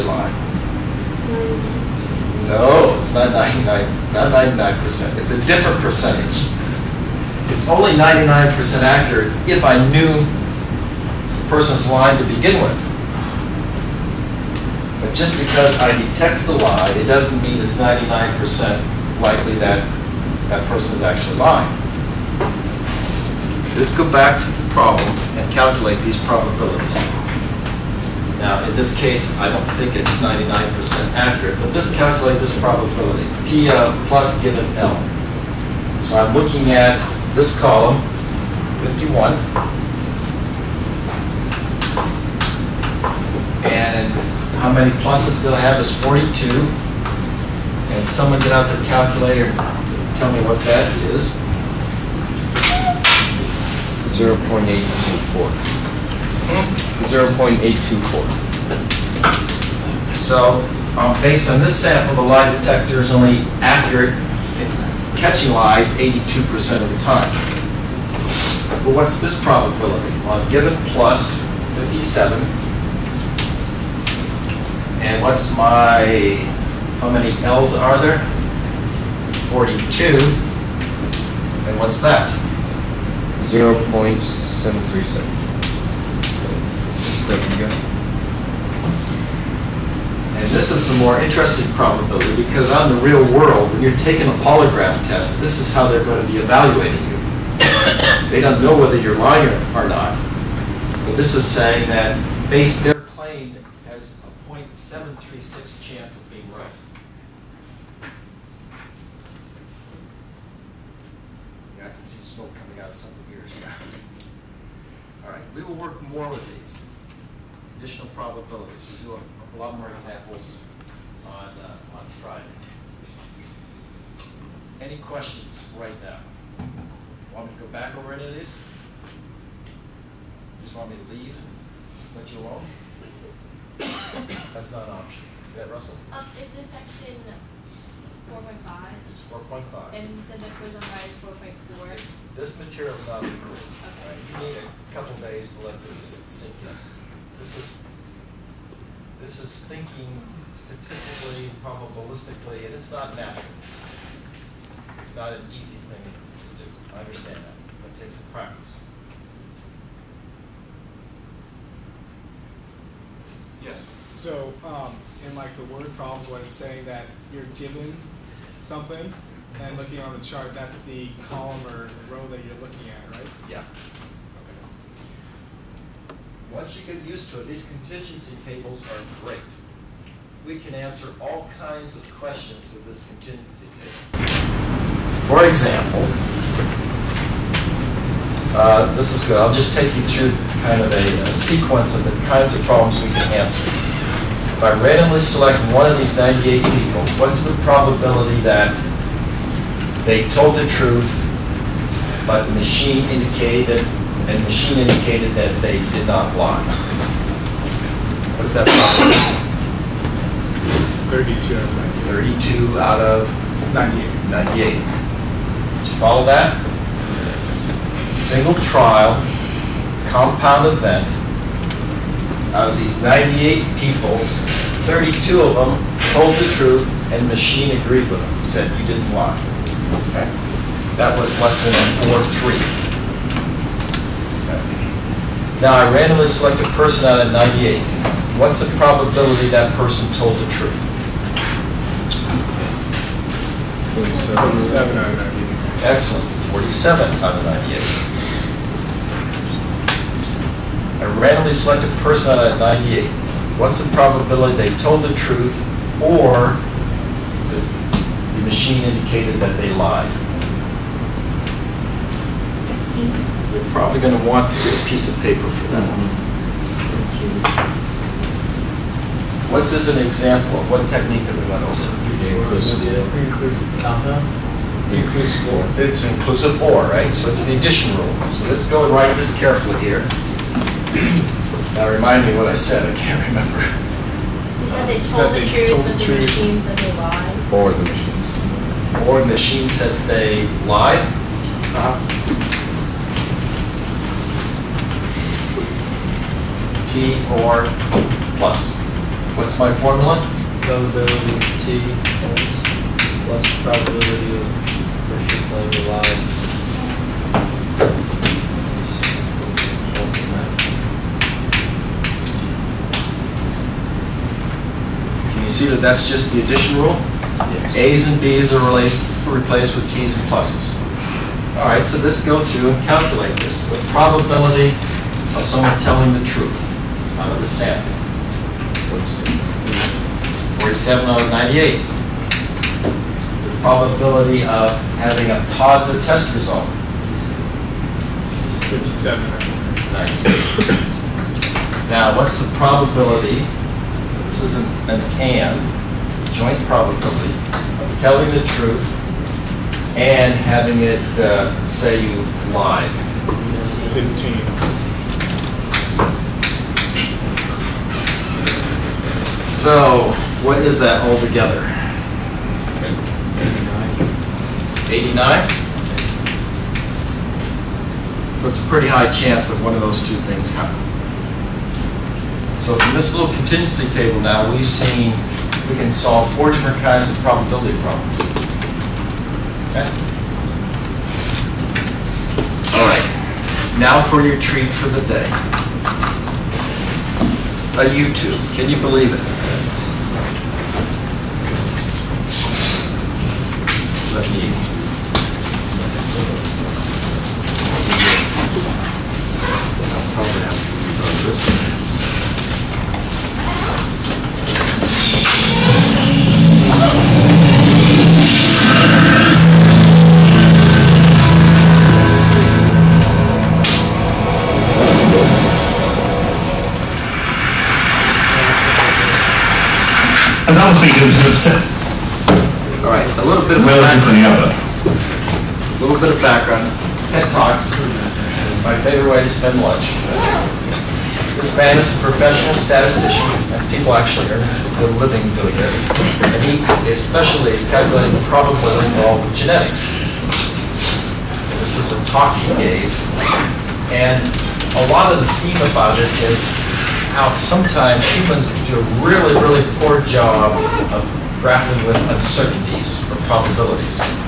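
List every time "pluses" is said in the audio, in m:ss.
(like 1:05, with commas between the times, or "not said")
0:45, 5:20.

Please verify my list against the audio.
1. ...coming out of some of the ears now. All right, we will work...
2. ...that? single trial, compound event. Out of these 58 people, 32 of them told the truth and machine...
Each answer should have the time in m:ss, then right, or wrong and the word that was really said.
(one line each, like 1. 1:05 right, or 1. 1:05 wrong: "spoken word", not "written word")
1. 1:52 right
2. 3:36 wrong: "98", not "58".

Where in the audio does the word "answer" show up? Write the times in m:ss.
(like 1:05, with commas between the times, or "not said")
3:00, 3:13.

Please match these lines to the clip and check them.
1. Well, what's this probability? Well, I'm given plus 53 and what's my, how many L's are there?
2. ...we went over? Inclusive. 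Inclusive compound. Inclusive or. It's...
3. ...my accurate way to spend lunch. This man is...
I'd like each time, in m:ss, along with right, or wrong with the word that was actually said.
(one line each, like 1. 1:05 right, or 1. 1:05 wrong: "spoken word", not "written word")
1. 1:08 wrong: "57", not "53"
2. 4:31 right
3. 7:08 wrong: "favorite", not "accurate".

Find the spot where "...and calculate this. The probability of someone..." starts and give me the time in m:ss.
5:22.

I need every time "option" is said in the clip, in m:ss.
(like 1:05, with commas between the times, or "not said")
2:15.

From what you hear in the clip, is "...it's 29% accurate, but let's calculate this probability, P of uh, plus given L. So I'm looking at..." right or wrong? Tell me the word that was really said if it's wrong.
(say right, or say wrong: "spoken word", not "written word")
wrong: "99", not "29".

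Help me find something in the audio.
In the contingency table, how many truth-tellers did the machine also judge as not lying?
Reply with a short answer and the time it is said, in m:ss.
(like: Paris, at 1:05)
32, at 3:31.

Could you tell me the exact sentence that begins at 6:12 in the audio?
So from this little contingency table now, we've seen we can solve four different kinds of probability problems.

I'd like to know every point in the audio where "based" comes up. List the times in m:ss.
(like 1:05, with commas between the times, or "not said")
1:01, 1:42.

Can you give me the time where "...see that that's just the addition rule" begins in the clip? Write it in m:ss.
5:15.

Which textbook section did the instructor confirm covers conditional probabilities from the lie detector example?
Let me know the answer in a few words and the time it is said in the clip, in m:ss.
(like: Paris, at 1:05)
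4.5, at 2:19.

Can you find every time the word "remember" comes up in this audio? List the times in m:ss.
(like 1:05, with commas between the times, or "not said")
4:43.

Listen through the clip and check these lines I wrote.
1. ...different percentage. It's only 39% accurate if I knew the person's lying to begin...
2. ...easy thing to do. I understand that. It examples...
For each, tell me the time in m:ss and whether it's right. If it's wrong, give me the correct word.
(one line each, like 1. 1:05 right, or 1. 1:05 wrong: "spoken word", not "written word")
1. 0:05 wrong: "99", not "39"
2. 2:35 wrong: "takes", not "examples".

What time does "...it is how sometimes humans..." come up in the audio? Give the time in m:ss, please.
7:25.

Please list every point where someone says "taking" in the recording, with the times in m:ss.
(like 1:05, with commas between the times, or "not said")
1:33.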